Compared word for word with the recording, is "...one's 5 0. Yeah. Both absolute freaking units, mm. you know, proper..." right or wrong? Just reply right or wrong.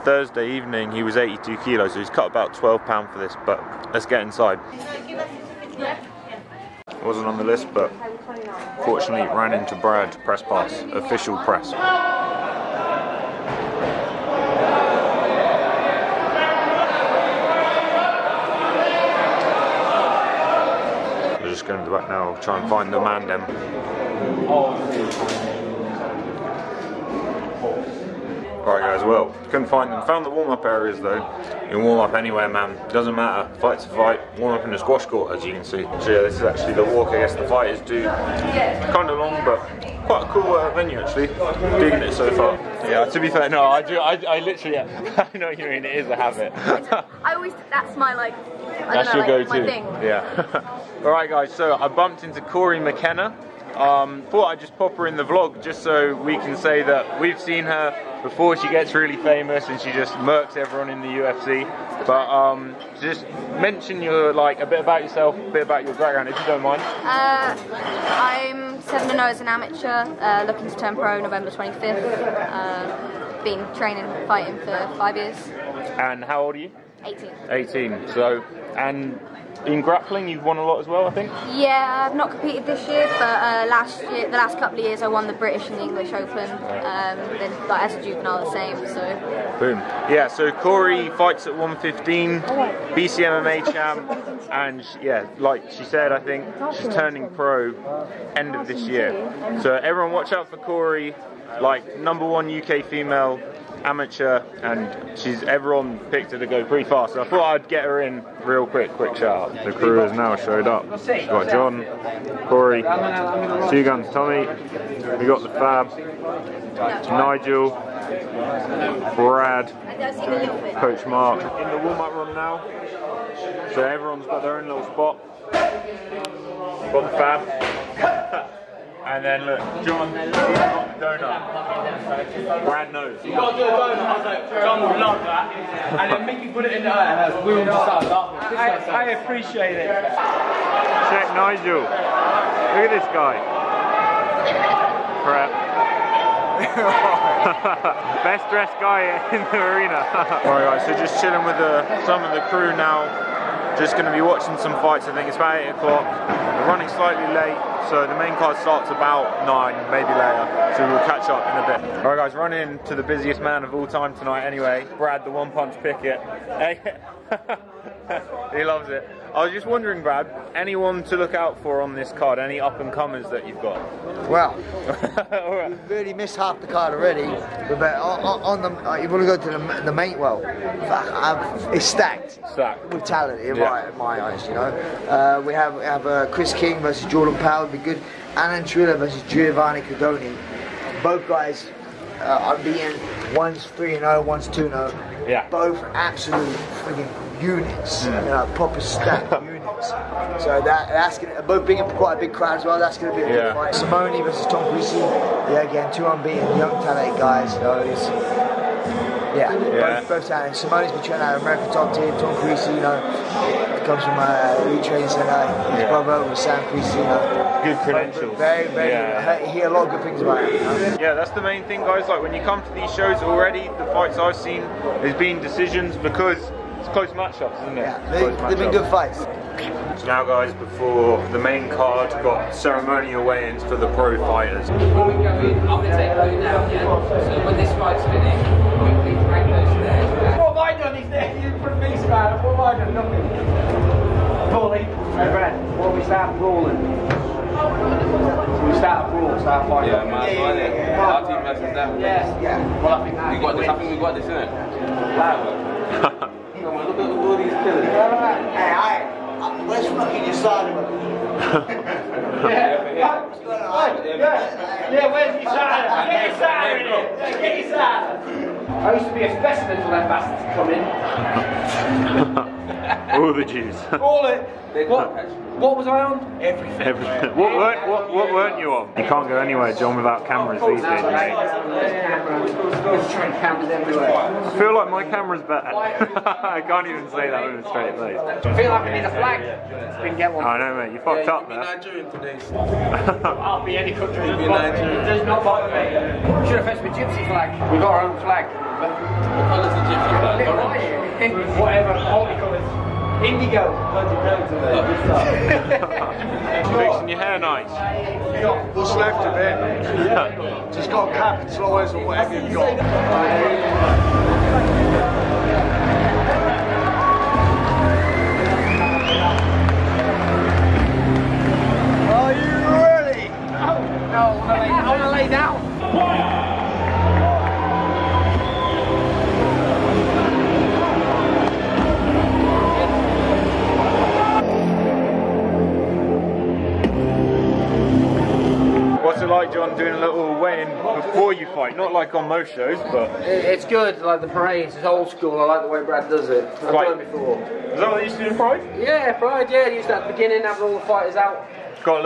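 wrong.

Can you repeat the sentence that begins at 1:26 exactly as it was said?
Um, then, like, as a juvenile, the same.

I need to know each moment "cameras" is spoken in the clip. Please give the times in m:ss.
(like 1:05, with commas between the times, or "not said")
4:40, 4:45.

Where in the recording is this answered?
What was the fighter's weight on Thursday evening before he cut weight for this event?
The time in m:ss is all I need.
0:01.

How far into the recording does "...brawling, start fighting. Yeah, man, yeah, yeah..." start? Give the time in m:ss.
4:09.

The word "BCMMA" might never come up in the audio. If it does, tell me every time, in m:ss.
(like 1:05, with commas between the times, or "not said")
1:32.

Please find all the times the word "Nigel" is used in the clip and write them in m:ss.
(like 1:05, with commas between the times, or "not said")
1:57, 2:21.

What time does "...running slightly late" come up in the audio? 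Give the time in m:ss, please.
2:36.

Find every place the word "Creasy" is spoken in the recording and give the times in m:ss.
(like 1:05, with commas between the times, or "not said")
3:24, 3:32, 3:36.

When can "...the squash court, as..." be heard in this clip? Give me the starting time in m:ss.
0:34.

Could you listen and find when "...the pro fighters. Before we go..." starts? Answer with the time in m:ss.
3:53.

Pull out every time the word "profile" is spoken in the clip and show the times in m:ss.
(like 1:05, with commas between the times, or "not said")
not said.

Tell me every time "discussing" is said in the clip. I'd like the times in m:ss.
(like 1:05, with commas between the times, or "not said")
not said.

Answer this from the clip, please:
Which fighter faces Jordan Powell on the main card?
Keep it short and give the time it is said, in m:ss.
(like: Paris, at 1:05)
Chris King, at 3:06.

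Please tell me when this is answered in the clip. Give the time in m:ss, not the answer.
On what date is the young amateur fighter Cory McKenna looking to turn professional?
1:11.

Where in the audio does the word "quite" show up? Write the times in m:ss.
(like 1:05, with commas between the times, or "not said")
0:40, 3:21.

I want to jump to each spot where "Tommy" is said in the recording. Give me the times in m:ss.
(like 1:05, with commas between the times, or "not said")
1:54.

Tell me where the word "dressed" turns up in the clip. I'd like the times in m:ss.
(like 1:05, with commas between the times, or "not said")
2:28.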